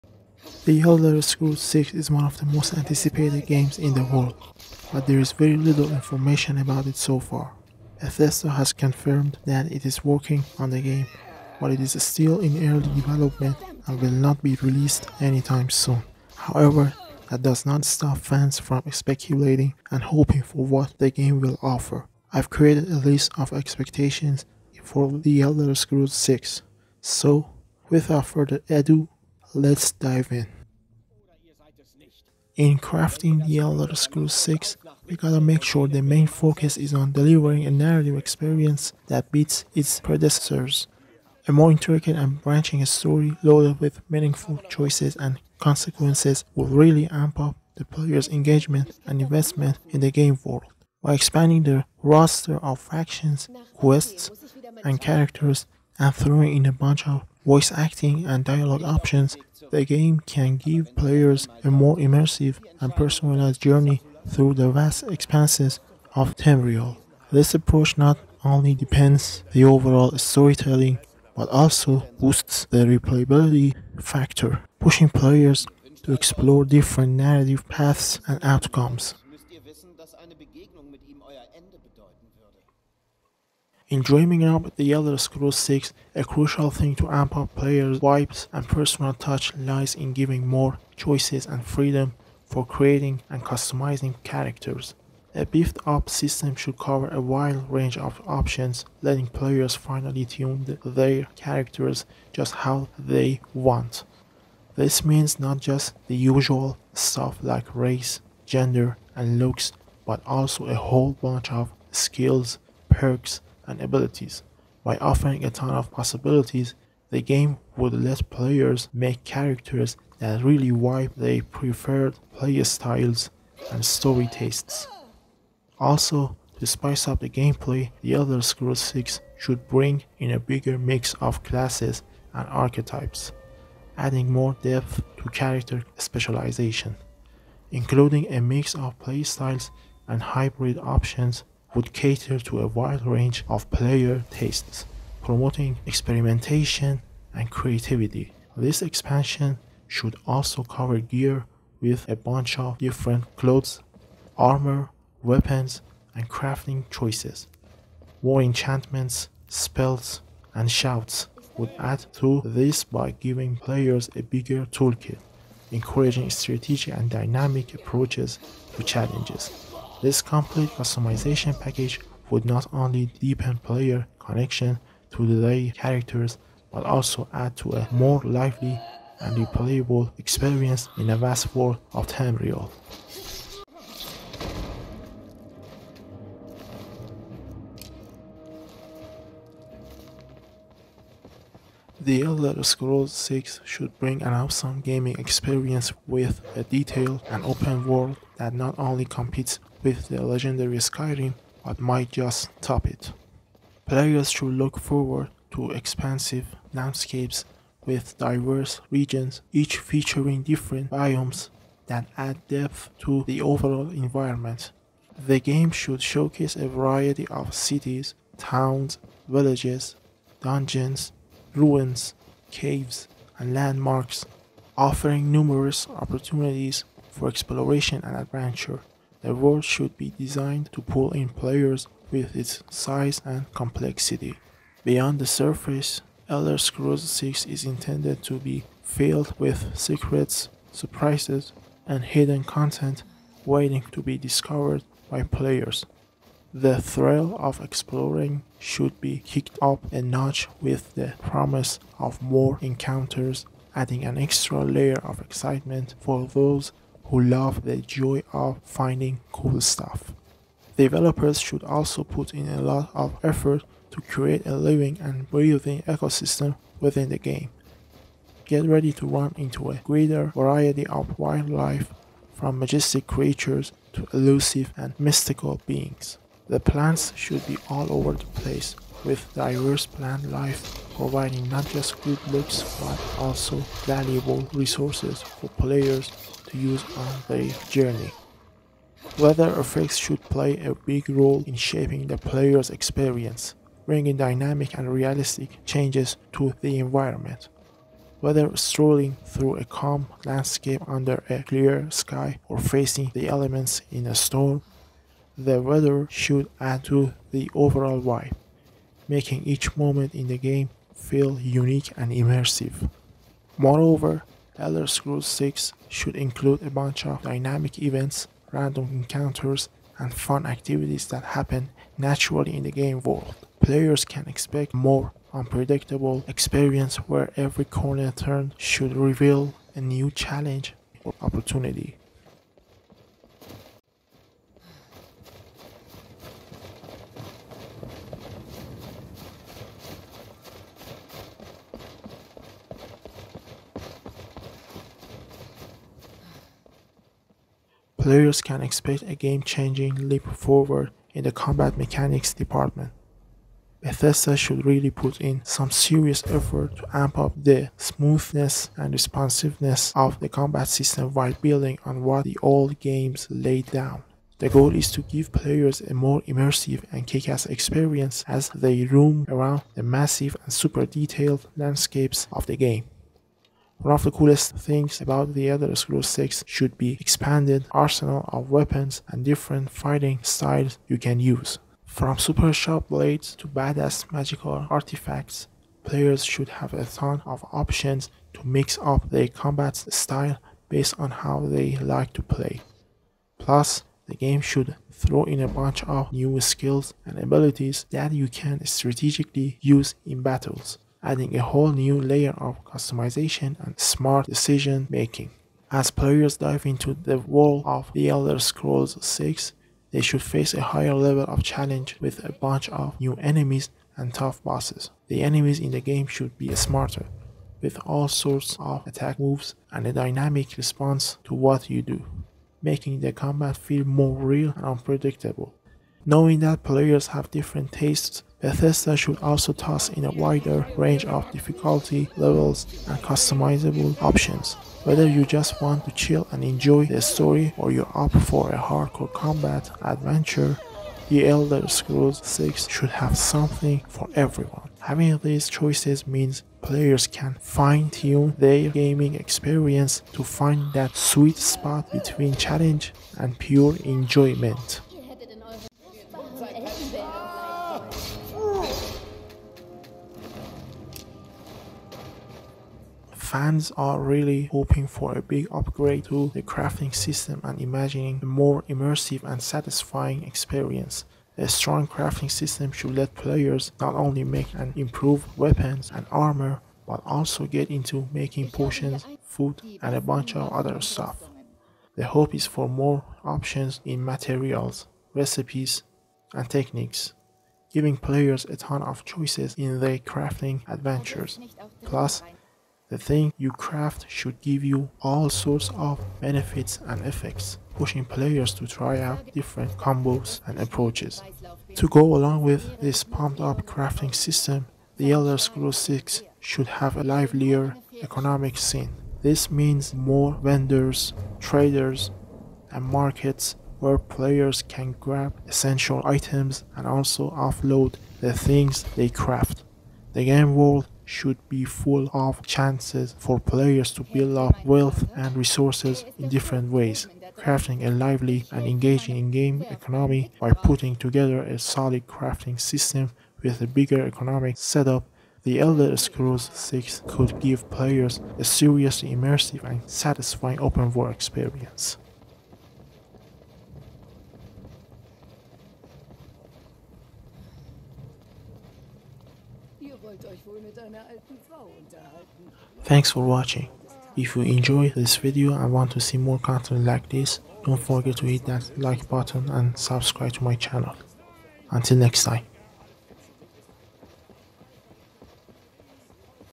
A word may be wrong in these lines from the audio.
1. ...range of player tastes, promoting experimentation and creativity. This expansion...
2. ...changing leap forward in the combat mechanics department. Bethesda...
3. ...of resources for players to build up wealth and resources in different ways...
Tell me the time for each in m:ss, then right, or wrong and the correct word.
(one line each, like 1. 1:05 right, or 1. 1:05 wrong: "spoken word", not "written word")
1. 2:23 right
2. 5:49 right
3. 8:42 wrong: "chances", not "resources".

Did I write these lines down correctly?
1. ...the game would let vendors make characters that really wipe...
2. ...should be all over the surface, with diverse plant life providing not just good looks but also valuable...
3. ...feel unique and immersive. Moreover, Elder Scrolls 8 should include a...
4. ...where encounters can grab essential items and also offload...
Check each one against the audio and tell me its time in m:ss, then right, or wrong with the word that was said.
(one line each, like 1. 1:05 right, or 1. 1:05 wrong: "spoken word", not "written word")
1. 1:57 wrong: "players", not "vendors"
2. 4:37 wrong: "place", not "surface"
3. 5:10 wrong: "6", not "8"
4. 8:33 wrong: "players", not "encounters".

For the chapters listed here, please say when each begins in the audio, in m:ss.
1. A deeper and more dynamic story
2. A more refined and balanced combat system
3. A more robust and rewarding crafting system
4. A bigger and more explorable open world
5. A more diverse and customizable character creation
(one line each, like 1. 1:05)
1. 0:33
2. 5:47
3. 7:43
4. 3:11
5. 1:24.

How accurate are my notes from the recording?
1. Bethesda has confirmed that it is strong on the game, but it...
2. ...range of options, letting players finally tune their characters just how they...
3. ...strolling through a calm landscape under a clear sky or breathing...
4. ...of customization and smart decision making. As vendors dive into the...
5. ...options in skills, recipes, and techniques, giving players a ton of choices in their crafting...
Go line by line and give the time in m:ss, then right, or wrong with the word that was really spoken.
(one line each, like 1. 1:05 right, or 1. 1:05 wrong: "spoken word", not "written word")
1. 0:07 wrong: "working", not "strong"
2. 1:37 right
3. 4:58 wrong: "facing", not "breathing"
4. 6:42 wrong: "players", not "vendors"
5. 8:03 wrong: "materials", not "skills".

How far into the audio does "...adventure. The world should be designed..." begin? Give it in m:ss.
3:48.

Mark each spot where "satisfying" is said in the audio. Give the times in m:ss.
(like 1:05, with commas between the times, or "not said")
7:49, 8:59.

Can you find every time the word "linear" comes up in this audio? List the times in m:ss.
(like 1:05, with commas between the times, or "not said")
not said.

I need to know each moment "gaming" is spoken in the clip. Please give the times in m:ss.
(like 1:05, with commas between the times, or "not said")
3:14, 7:28.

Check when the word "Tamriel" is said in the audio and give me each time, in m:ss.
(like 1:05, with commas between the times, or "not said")
1:06, 3:02.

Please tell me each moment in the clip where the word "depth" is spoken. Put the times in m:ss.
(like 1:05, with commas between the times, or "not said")
2:14, 3:32.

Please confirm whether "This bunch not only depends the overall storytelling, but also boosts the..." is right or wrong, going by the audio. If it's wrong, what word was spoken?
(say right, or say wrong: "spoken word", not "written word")
wrong: "approach", not "bunch".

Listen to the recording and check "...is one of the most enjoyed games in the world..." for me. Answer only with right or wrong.
wrong.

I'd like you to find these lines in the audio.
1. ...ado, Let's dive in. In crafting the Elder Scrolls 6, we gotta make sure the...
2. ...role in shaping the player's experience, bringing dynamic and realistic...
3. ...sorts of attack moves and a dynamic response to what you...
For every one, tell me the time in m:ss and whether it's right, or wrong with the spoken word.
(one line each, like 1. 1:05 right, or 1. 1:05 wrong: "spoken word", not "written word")
1. 0:28 right
2. 4:51 right
3. 6:58 right.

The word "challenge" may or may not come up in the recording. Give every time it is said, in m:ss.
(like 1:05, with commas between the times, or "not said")
2:48, 5:30, 6:51, 7:32.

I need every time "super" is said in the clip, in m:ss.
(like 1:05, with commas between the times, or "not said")
6:10, 6:22.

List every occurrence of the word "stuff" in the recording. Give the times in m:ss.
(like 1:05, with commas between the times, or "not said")
1:46, 4:19, 8:00.